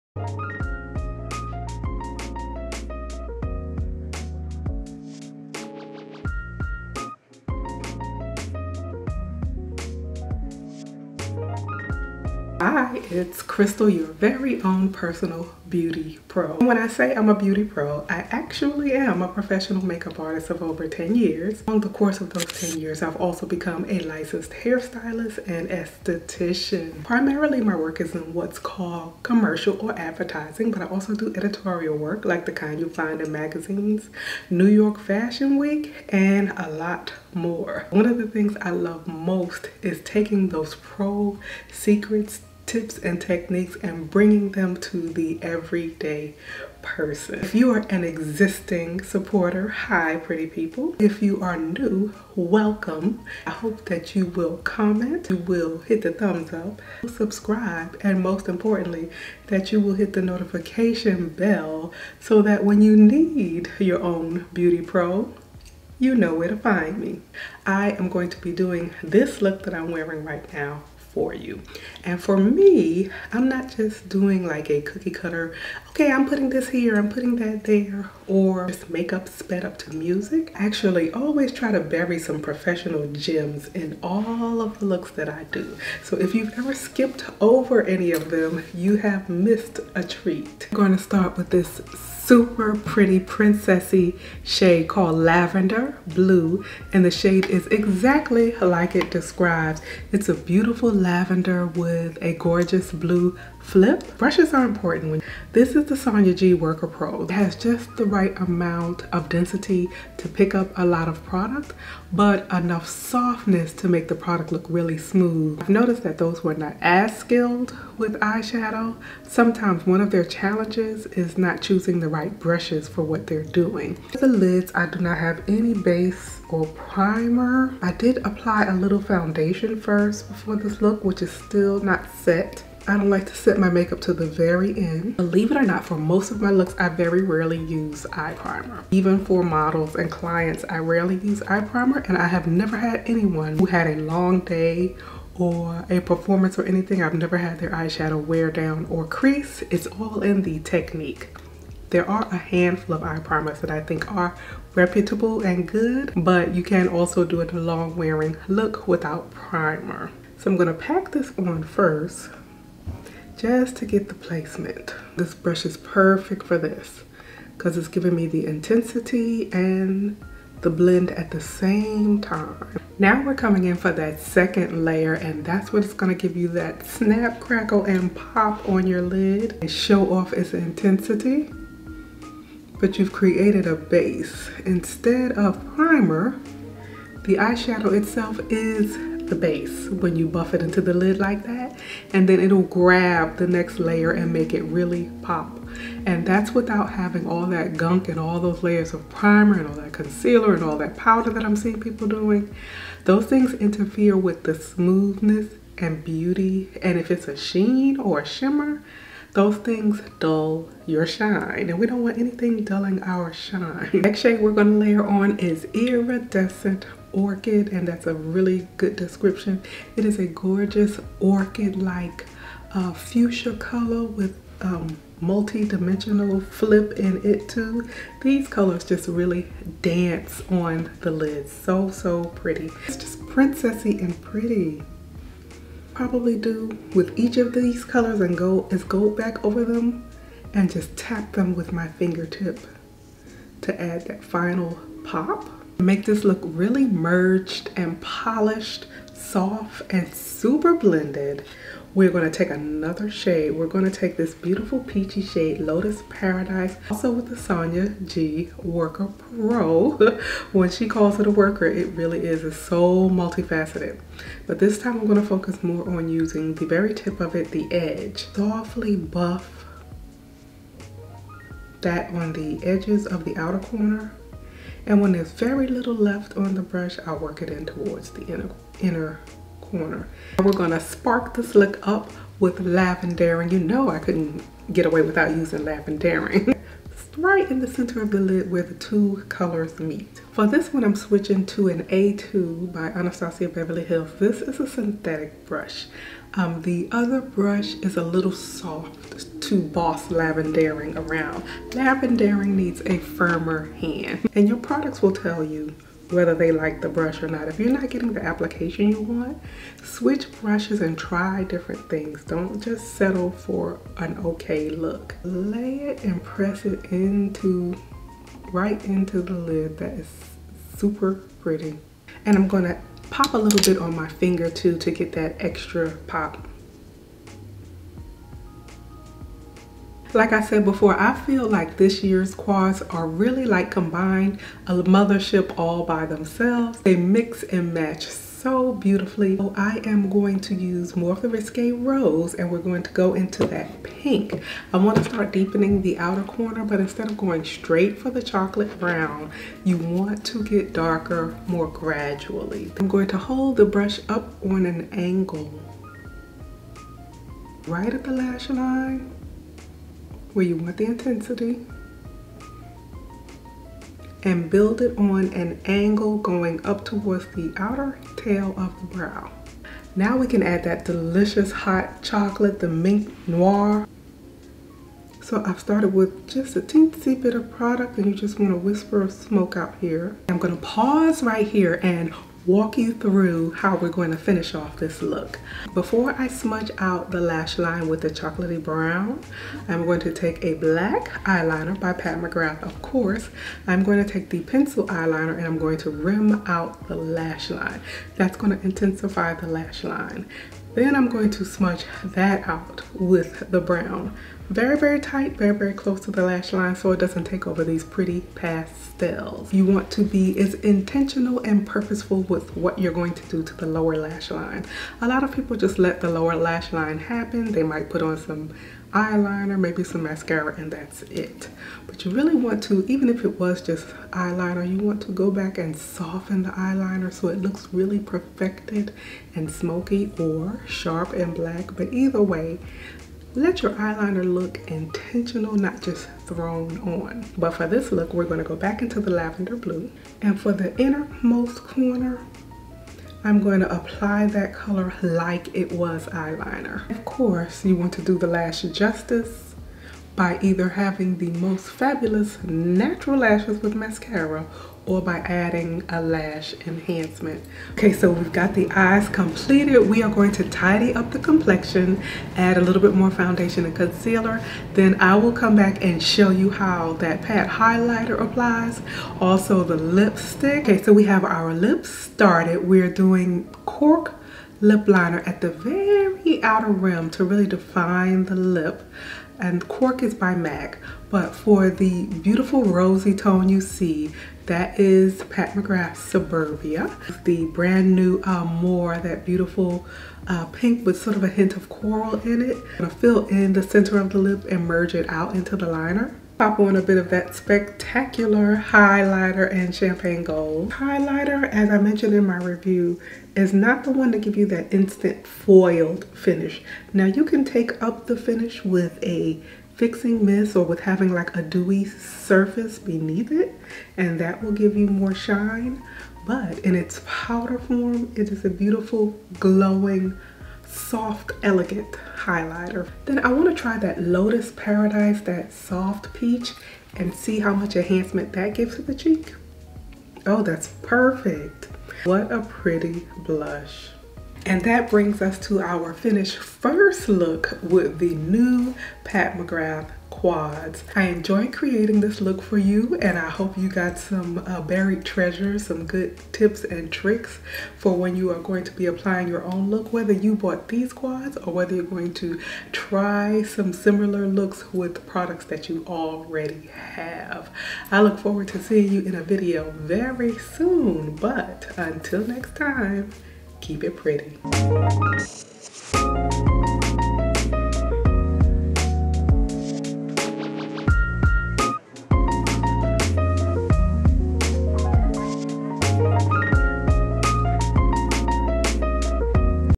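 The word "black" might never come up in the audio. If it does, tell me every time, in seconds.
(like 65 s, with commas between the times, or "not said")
390 s, 431 s.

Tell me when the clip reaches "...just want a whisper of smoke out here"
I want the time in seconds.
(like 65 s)
378 s.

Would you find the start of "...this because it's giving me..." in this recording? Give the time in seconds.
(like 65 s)
166 s.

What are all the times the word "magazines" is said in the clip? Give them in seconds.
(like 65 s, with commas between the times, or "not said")
33 s.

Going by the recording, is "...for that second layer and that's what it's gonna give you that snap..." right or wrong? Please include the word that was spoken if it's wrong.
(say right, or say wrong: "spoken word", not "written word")
right.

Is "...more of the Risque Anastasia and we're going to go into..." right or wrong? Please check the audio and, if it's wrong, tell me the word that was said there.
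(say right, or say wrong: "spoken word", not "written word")
wrong: "Rose", not "Anastasia".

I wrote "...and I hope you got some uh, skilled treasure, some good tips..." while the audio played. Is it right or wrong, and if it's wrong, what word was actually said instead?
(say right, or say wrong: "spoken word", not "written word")
wrong: "buried", not "skilled".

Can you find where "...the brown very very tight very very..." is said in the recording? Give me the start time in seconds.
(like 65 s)
403 s.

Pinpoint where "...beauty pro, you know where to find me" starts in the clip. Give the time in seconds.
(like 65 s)
64 s.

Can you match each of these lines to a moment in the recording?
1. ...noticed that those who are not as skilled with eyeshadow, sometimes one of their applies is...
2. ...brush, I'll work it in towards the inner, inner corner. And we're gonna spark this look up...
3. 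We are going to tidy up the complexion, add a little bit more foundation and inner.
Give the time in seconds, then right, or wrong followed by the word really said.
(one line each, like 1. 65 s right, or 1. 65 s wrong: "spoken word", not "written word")
1. 115 s wrong: "challenges", not "applies"
2. 276 s right
3. 459 s wrong: "concealer", not "inner".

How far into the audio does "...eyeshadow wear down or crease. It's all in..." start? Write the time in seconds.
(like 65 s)
147 s.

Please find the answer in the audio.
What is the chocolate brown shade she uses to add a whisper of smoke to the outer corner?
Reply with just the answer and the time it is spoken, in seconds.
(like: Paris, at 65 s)
Mink Noir, at 372 s.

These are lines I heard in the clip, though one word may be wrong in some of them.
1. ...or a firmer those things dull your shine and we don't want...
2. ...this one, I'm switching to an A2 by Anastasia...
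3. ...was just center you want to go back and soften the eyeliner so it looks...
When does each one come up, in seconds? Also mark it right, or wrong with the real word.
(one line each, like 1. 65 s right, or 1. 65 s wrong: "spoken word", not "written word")
1. 208 s wrong: "shimmer", not "firmer"
2. 290 s right
3. 423 s wrong: "eyeliner", not "center".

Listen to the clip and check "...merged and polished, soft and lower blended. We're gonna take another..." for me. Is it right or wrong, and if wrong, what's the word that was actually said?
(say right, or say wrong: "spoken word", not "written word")
wrong: "super", not "lower".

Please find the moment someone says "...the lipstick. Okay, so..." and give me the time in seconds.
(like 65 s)
469 s.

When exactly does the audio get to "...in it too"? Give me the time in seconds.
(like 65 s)
226 s.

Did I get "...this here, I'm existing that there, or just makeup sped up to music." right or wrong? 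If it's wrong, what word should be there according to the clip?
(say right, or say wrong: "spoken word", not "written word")
wrong: "putting", not "existing".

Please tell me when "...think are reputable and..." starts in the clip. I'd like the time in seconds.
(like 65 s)
153 s.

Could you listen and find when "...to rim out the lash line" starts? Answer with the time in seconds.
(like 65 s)
395 s.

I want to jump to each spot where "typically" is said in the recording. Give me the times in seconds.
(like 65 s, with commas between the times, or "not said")
not said.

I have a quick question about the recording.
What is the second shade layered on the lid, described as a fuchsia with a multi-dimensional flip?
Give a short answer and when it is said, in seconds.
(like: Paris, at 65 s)
Iridescent Orchid, at 215 s.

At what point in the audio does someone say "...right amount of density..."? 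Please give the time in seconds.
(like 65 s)
108 s.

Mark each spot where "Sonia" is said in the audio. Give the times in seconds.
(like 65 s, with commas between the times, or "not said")
105 s, 257 s.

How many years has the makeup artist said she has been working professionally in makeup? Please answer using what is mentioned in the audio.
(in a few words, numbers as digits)
10.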